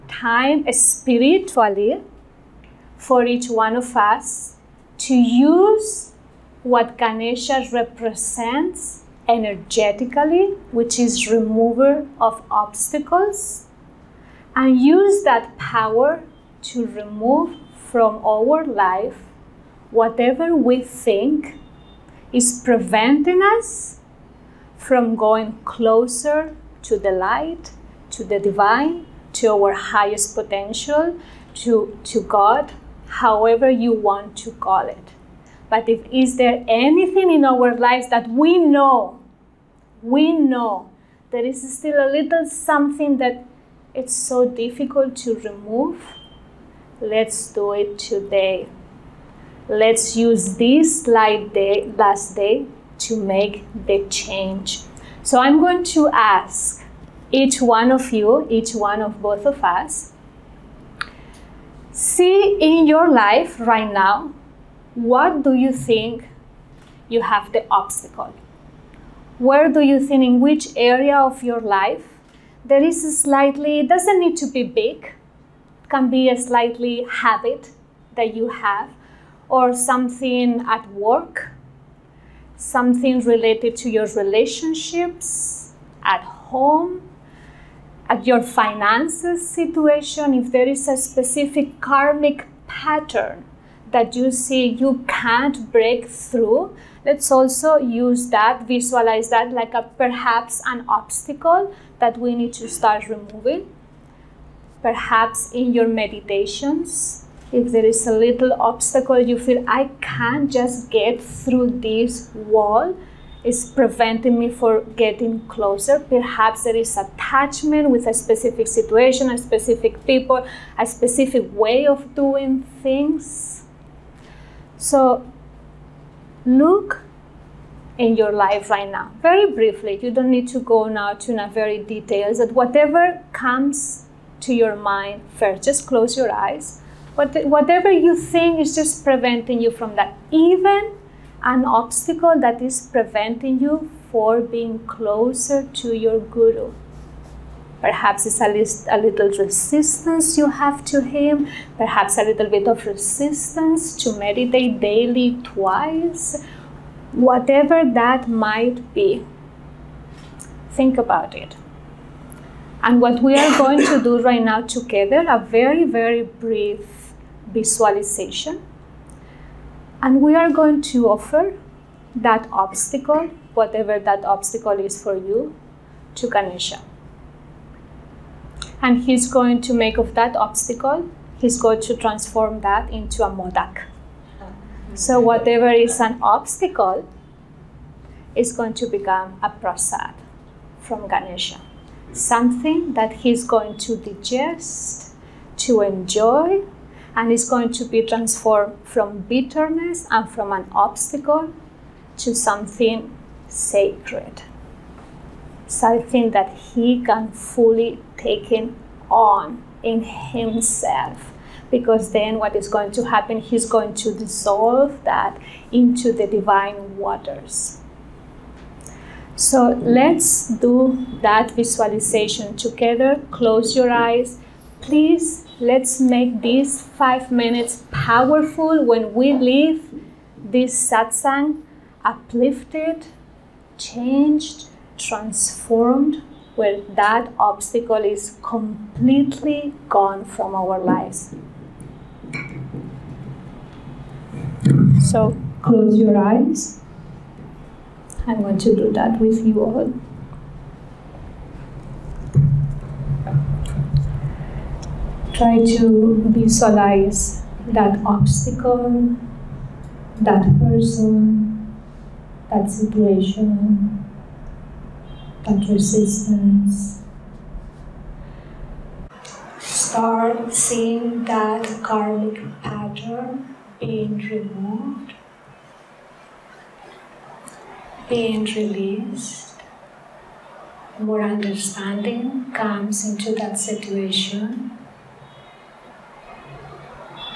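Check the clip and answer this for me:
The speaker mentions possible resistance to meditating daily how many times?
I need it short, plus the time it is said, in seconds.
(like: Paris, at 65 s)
Twice, at 155 s.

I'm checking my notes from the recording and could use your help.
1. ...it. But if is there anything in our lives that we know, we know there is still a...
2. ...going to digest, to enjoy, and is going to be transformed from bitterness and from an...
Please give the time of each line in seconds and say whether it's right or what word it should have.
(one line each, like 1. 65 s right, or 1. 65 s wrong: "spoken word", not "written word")
1. 34 s right
2. 193 s right.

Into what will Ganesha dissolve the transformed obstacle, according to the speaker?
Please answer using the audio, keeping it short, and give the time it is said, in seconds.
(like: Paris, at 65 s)
The divine waters, at 216 s.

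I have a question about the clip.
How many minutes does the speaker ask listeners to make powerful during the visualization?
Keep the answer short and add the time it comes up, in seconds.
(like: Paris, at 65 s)
5, at 226 s.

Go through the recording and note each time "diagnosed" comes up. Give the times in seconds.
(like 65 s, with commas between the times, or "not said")
not said.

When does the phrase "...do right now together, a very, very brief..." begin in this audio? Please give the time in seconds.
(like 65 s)
164 s.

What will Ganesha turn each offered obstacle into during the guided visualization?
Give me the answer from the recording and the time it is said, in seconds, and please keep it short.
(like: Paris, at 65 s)
A modak, at 183 s.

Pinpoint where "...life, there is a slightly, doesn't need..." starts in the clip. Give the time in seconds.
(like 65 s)
71 s.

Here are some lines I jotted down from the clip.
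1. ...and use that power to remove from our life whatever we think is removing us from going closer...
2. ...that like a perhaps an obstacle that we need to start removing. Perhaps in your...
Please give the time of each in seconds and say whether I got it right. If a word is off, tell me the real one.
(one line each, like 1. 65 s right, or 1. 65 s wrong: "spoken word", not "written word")
1. 14 s wrong: "preventing", not "removing"
2. 99 s right.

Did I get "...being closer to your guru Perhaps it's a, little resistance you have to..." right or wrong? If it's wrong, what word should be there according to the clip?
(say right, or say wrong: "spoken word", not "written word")
right.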